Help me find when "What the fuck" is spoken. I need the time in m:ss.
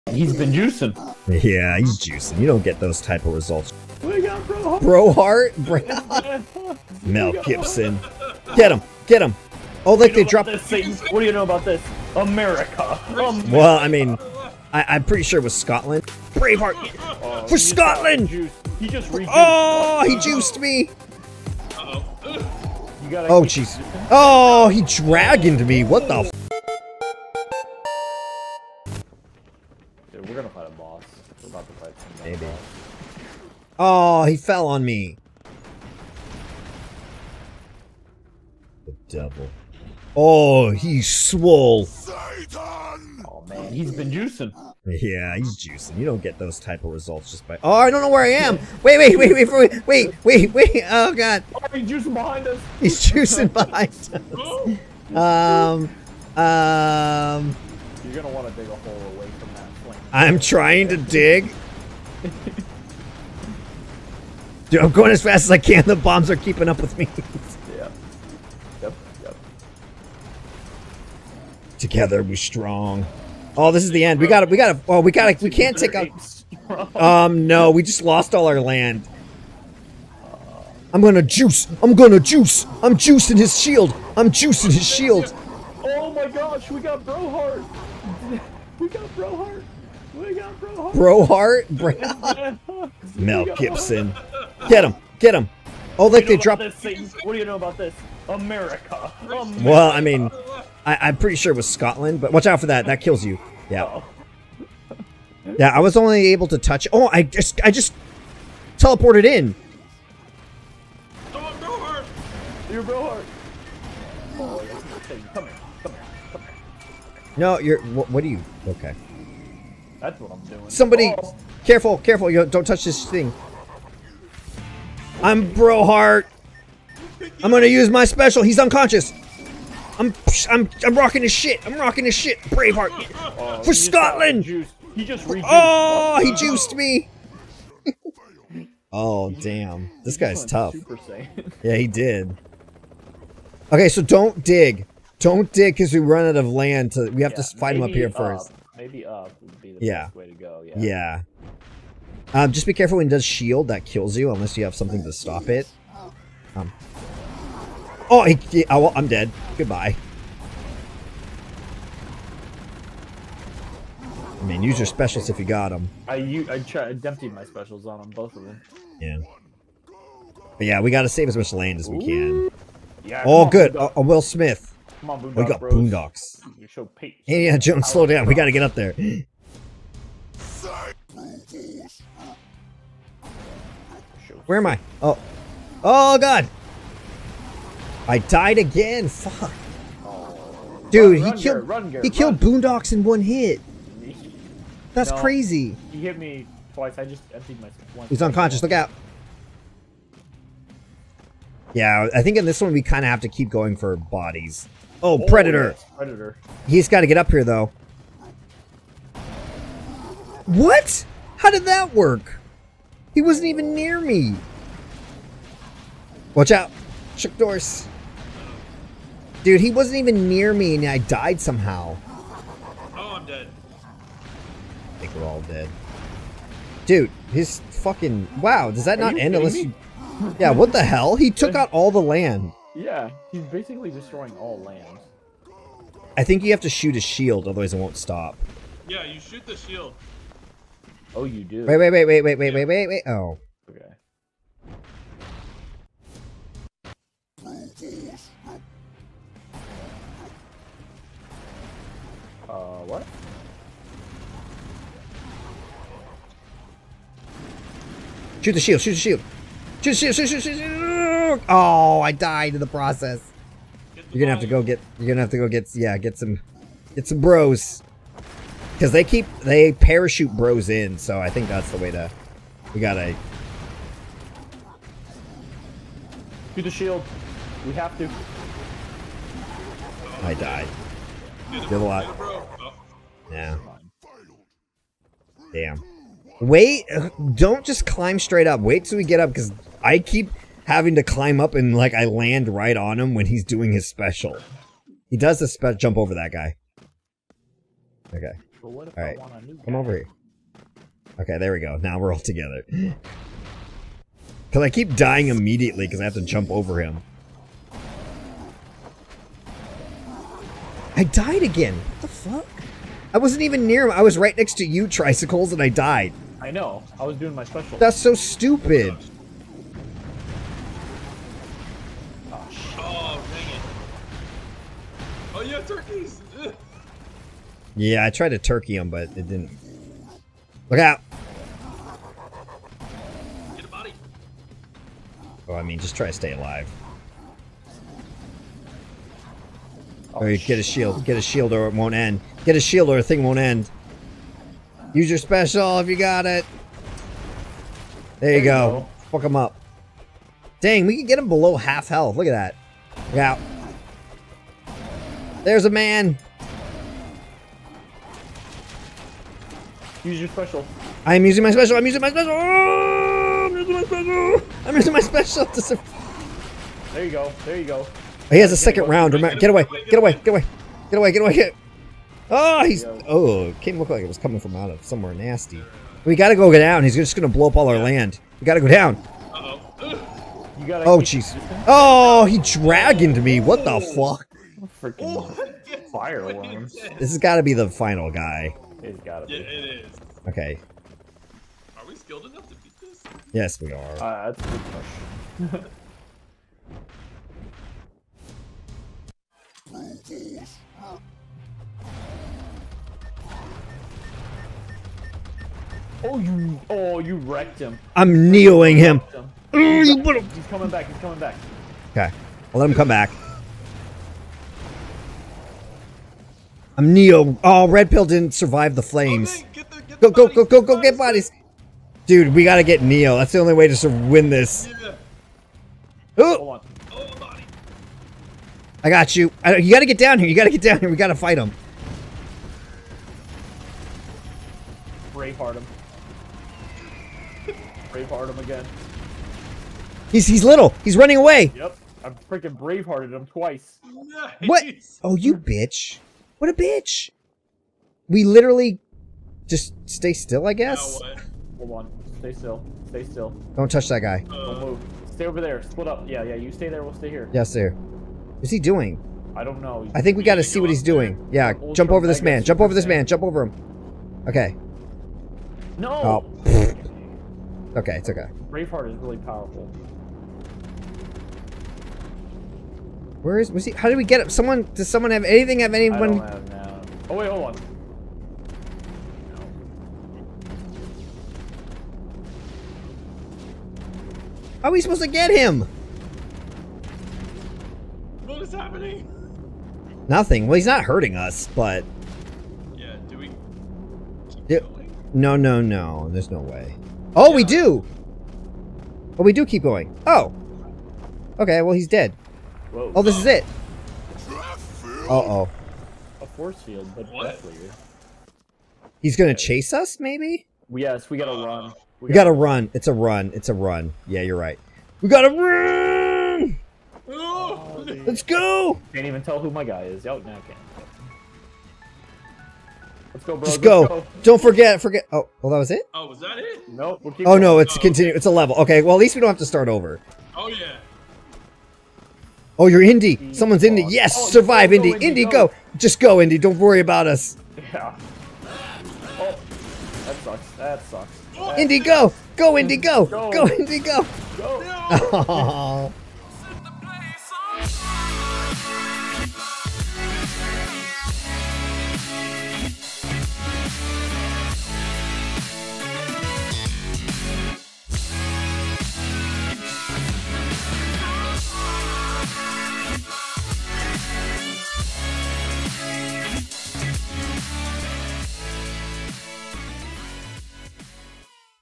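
5:11.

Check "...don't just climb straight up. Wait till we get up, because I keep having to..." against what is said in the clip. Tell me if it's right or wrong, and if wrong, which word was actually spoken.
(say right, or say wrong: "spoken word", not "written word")
right.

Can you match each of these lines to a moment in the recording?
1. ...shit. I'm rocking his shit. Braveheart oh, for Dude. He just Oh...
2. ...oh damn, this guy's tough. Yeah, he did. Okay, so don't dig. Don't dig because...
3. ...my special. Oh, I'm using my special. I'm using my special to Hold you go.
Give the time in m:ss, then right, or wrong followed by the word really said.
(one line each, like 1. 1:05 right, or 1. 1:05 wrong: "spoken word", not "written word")
1. 2:11 wrong: "Scotland", not "Dude"
2. 2:18 right
3. 6:02 wrong: "There", not "Hold".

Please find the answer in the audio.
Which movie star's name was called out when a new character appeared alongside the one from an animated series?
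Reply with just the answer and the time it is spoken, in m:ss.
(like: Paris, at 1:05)
Will Smith, at 2:54.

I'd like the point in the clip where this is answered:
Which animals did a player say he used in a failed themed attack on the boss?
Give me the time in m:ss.
5:25.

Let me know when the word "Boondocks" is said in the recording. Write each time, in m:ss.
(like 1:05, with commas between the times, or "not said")
2:55, 3:12.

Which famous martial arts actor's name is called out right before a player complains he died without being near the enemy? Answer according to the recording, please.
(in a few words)
Chuck Norris.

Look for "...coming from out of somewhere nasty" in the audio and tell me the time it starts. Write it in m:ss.
6:14.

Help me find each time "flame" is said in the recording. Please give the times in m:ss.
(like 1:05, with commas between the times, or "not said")
0:59, 6:58.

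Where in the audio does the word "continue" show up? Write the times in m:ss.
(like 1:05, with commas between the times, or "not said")
8:47.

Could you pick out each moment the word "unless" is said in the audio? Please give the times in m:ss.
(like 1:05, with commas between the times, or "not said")
2:34, 3:49.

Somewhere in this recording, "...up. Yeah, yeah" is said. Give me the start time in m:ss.
7:35.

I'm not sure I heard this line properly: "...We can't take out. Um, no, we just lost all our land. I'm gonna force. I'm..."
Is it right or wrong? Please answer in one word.
wrong.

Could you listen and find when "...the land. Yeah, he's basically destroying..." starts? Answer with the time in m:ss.
3:51.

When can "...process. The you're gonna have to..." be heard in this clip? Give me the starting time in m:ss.
4:22.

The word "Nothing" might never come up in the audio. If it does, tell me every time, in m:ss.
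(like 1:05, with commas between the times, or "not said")
8:10.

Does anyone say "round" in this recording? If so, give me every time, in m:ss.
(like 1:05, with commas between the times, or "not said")
6:08.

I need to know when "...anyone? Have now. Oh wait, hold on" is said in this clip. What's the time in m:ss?
7:55.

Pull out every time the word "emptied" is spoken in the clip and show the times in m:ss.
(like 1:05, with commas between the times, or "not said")
2:47, 3:17.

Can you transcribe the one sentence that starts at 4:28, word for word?
Because they keep, they parachute bros in, so I think that's the way to, we gotta.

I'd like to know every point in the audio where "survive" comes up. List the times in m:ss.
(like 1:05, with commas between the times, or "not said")
6:58, 8:54.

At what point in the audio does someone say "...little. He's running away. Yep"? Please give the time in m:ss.
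7:20.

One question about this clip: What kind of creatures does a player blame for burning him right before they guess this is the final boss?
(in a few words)
fire worms.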